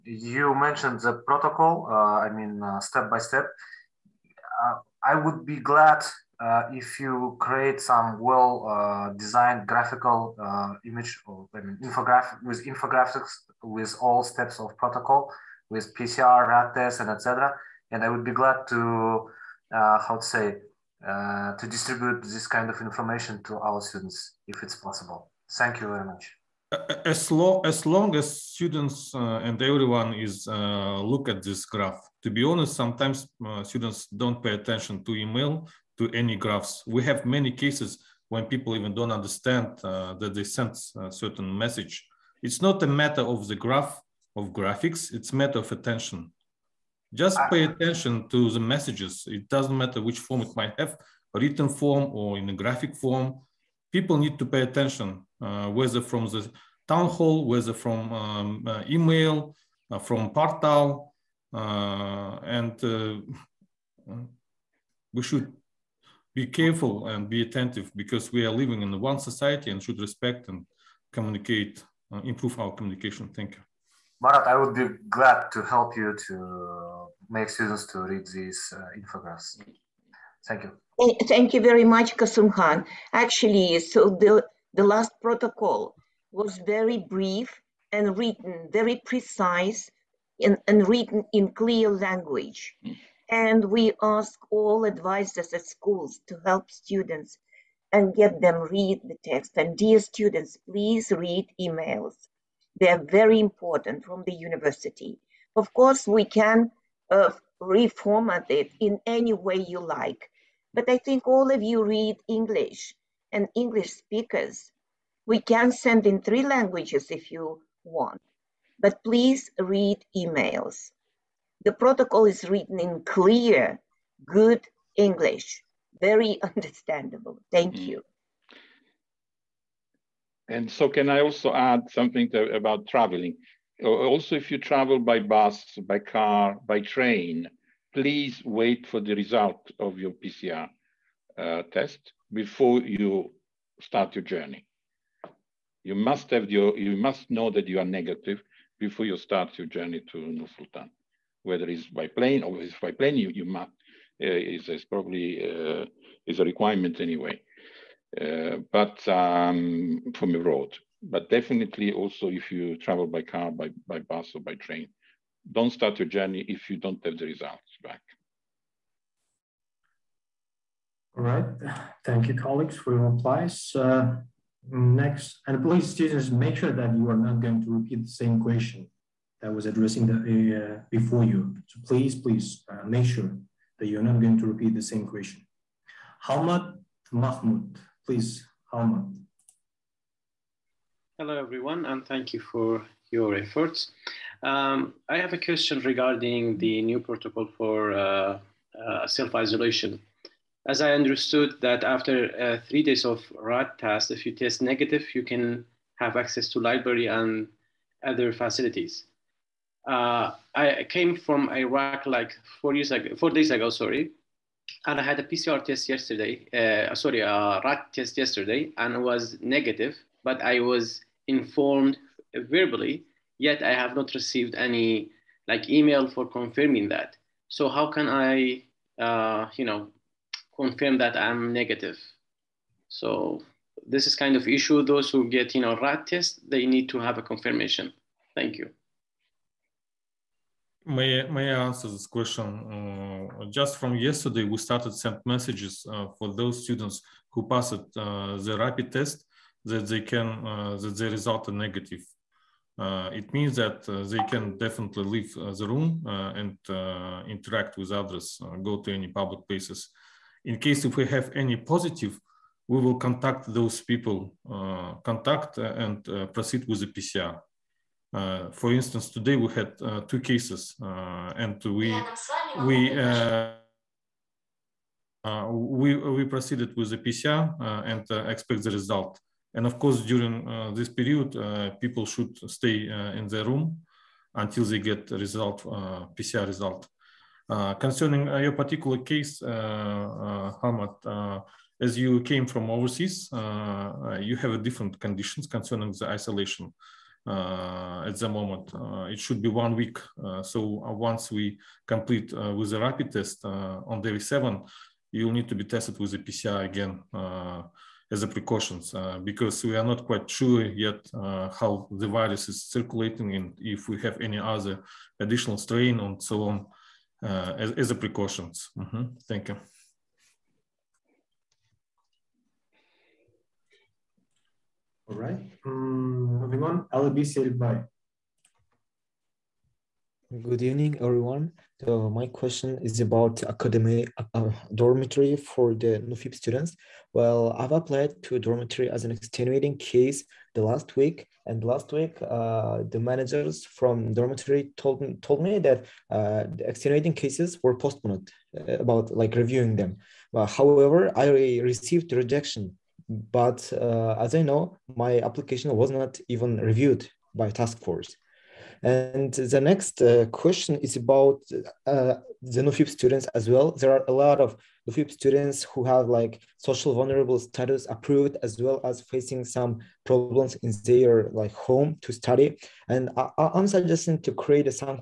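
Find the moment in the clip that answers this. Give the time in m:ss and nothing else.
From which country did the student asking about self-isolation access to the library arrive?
3:31.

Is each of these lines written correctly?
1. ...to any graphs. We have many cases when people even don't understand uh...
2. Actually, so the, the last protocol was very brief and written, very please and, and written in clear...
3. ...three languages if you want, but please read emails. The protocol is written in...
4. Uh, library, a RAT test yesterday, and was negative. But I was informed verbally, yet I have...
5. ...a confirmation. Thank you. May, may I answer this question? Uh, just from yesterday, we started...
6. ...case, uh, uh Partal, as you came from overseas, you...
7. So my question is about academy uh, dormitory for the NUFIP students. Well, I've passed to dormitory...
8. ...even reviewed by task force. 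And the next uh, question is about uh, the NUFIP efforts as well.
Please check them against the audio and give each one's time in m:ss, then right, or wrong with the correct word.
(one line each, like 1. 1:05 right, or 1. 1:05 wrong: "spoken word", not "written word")
1. 0:35 right
2. 1:23 wrong: "precise", not "please"
3. 1:56 right
4. 3:36 wrong: "sorry", not "library"
5. 3:57 right
6. 4:48 wrong: "Hamad", not "Partal"
7. 5:31 wrong: "applied", not "passed"
8. 5:56 wrong: "students", not "efforts".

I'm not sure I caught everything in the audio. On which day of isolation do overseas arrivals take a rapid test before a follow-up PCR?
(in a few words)
day 7.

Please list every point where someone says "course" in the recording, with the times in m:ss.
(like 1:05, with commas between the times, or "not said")
1:45, 4:39.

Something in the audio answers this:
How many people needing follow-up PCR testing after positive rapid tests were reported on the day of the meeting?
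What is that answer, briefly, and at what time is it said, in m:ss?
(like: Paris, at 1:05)
2, at 4:30.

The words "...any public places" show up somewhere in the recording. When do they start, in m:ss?
4:18.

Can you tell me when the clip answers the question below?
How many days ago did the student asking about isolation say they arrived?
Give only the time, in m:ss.
3:33.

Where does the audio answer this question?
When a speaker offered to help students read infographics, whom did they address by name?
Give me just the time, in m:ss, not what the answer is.
1:14.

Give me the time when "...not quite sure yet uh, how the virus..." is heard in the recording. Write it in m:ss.
5:09.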